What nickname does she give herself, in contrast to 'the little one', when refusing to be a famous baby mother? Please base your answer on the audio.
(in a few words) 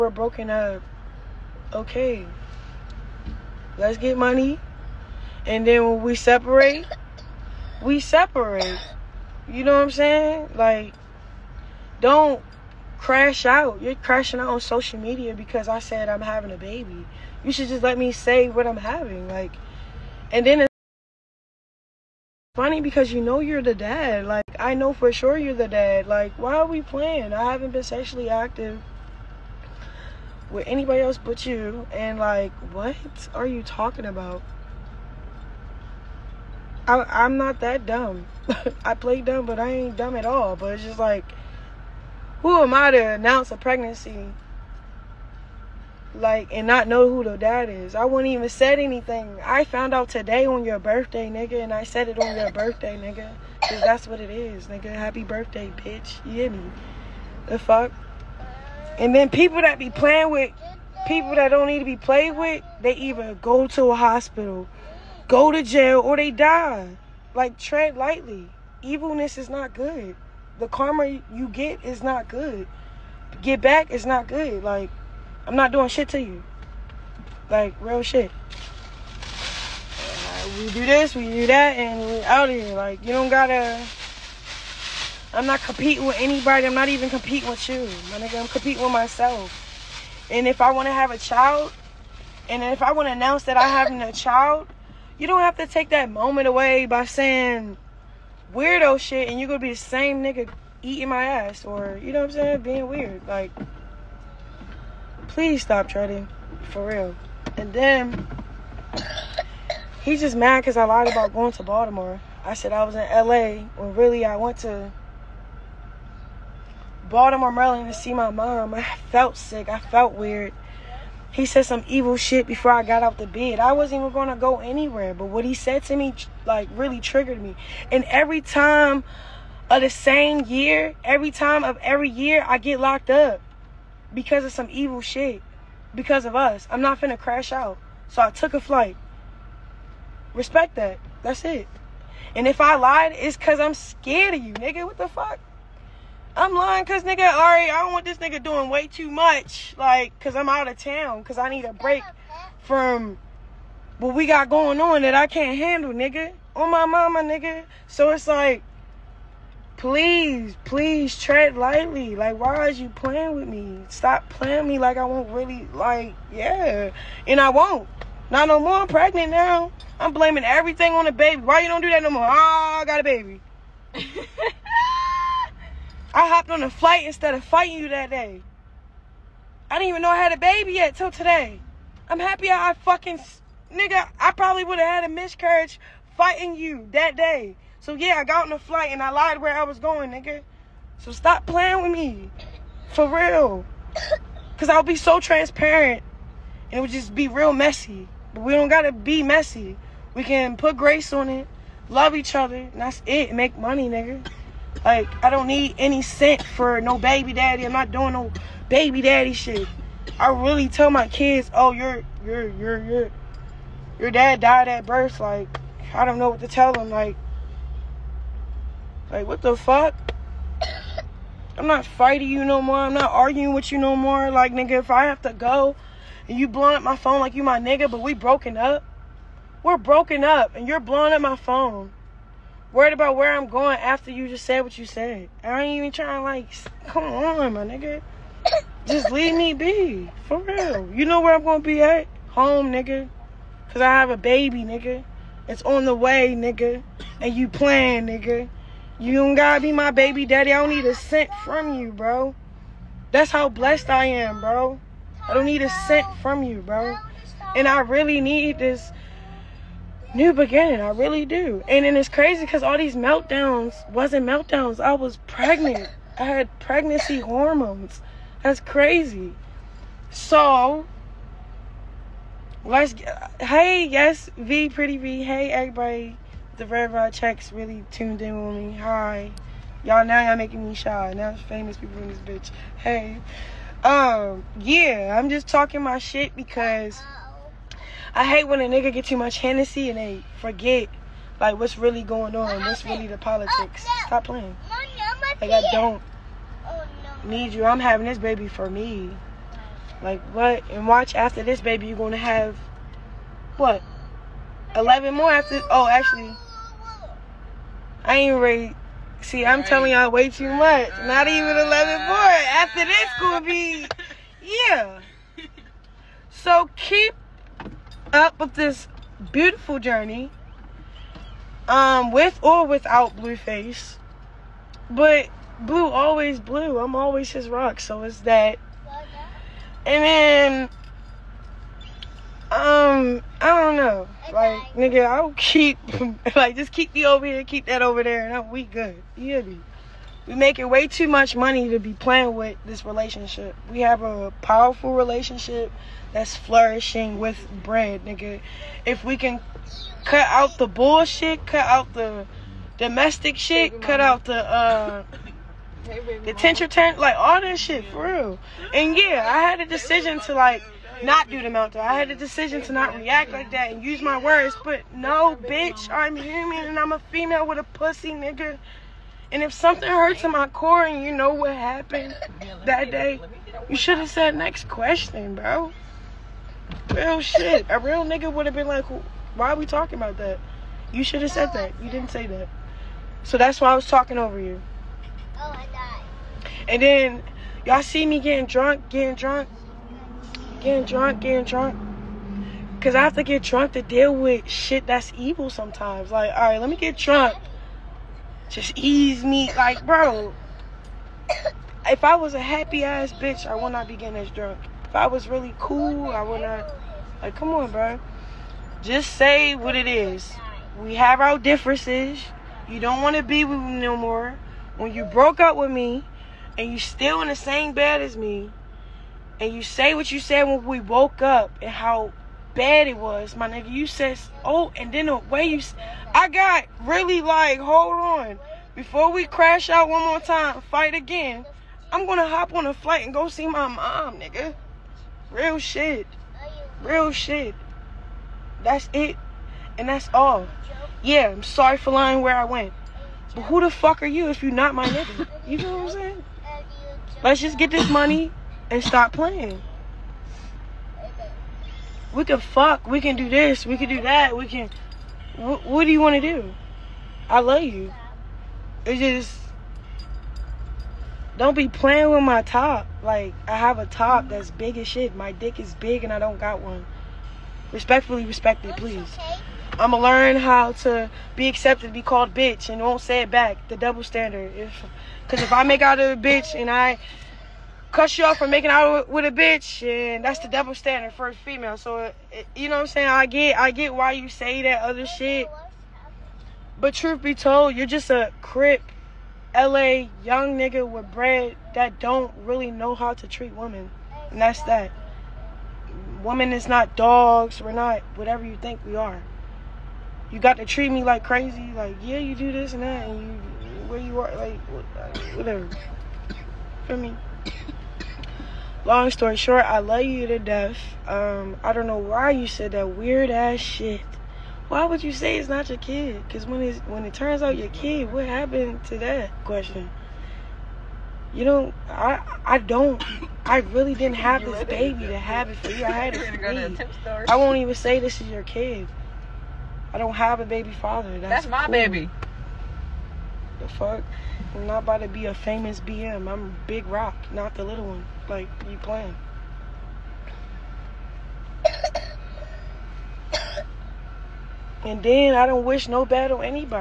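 Big Rock.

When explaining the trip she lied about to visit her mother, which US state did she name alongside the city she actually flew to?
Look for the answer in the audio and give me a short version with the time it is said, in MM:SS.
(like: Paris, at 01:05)
Maryland, at 01:57.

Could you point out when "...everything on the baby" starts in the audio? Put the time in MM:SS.
02:50.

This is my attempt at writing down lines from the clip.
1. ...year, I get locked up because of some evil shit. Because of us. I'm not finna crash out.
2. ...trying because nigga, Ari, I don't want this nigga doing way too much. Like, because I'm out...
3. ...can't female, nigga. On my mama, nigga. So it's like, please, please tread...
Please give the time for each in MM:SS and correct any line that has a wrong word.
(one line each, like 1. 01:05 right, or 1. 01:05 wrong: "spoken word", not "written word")
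1. 02:12 right
2. 02:26 wrong: "lying", not "trying"
3. 02:35 wrong: "handle", not "female".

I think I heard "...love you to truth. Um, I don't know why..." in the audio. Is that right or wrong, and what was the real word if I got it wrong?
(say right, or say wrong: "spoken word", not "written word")
wrong: "death", not "truth".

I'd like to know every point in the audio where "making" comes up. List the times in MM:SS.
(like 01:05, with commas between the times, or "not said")
04:40, 05:40, 07:58.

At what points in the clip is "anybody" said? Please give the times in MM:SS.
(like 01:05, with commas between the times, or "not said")
00:30, 01:26.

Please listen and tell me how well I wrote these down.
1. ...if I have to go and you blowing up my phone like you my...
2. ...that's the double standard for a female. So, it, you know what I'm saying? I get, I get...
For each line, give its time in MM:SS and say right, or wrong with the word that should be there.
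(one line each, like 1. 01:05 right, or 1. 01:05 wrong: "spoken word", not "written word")
1. 03:44 right
2. 08:00 right.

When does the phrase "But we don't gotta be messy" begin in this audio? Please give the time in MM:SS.
03:18.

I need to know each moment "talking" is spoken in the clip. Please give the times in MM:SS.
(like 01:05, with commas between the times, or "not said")
00:33, 04:45, 06:19, 06:23.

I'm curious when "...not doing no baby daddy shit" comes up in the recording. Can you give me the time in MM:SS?
03:27.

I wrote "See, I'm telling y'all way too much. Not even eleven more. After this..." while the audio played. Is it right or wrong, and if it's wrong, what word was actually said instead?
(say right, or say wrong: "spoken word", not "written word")
right.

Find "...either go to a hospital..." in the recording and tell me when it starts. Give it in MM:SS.
01:02.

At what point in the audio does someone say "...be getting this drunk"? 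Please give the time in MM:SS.
06:43.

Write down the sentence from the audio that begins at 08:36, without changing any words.
Because when it's, when it turns out your kid, what happened to that question?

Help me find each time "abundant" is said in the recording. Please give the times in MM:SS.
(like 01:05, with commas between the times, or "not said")
not said.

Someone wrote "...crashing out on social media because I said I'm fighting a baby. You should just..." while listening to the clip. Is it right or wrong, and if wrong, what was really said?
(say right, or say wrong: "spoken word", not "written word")
wrong: "having", not "fighting".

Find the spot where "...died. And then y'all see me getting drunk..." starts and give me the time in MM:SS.
06:25.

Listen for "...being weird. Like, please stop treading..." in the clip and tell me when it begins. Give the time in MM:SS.
01:42.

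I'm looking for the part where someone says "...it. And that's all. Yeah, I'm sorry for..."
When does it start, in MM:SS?
07:18.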